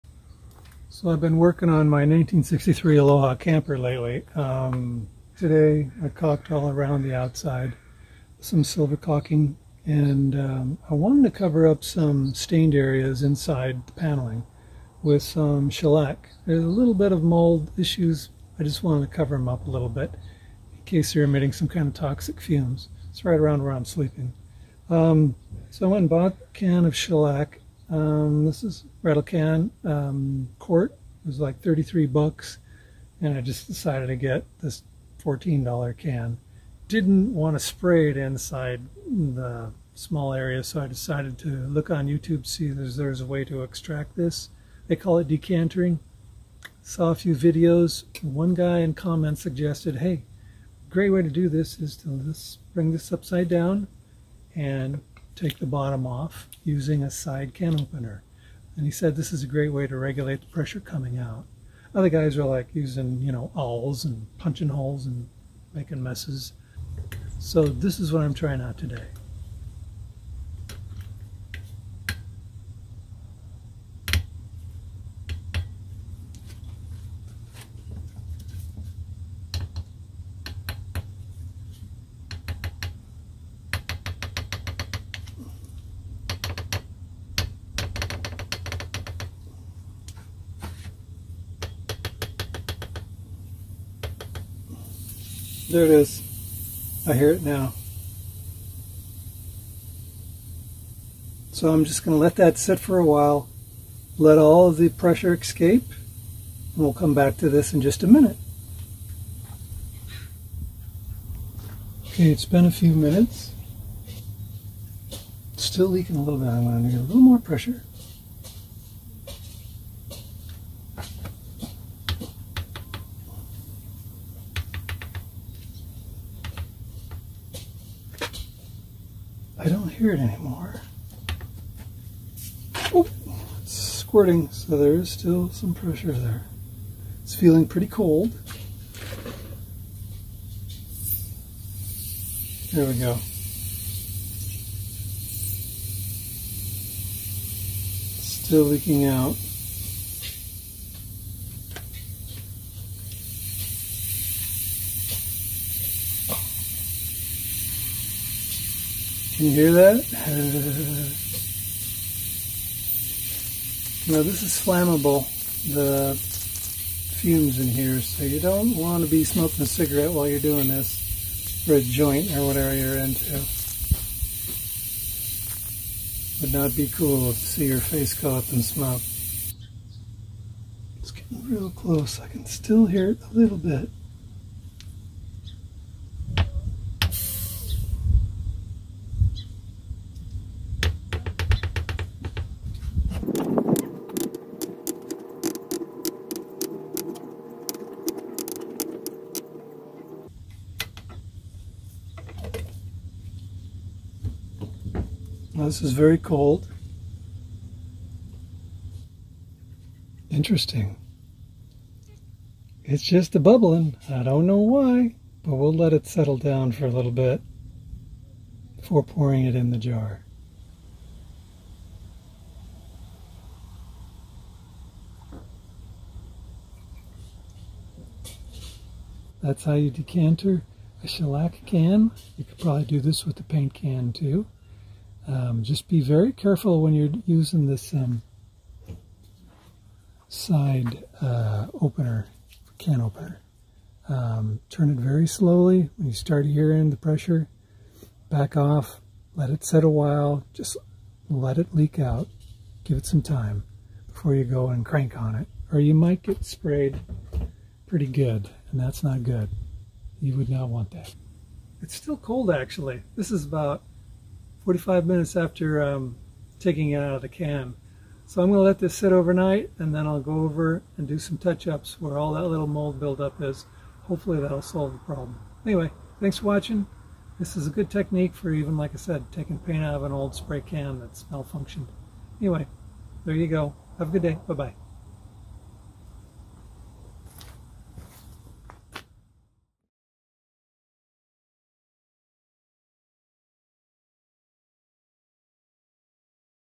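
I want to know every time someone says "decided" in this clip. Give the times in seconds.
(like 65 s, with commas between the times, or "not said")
33 s, 40 s.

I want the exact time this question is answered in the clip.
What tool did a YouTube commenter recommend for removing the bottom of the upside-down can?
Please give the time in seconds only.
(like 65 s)
57 s.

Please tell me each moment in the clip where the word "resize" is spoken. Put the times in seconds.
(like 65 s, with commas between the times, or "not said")
not said.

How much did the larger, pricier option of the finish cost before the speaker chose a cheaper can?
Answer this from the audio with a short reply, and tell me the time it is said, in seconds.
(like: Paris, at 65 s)
$33, at 31 s.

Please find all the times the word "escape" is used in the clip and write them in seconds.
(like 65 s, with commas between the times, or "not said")
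105 s.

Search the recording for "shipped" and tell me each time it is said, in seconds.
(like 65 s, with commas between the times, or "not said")
not said.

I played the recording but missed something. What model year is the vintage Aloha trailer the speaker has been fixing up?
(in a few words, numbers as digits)
1963.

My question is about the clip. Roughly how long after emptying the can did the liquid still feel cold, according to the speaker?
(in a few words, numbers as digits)
45 minutes.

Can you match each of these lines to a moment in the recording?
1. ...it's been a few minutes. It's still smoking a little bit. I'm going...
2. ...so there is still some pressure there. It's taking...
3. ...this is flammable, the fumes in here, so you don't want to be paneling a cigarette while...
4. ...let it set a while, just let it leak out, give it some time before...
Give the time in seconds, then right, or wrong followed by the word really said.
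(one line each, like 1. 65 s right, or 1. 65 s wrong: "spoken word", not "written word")
1. 112 s wrong: "leaking", not "smoking"
2. 134 s wrong: "feeling", not "taking"
3. 164 s wrong: "smoking", not "paneling"
4. 249 s right.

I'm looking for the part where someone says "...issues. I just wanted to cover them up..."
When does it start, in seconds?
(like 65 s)
17 s.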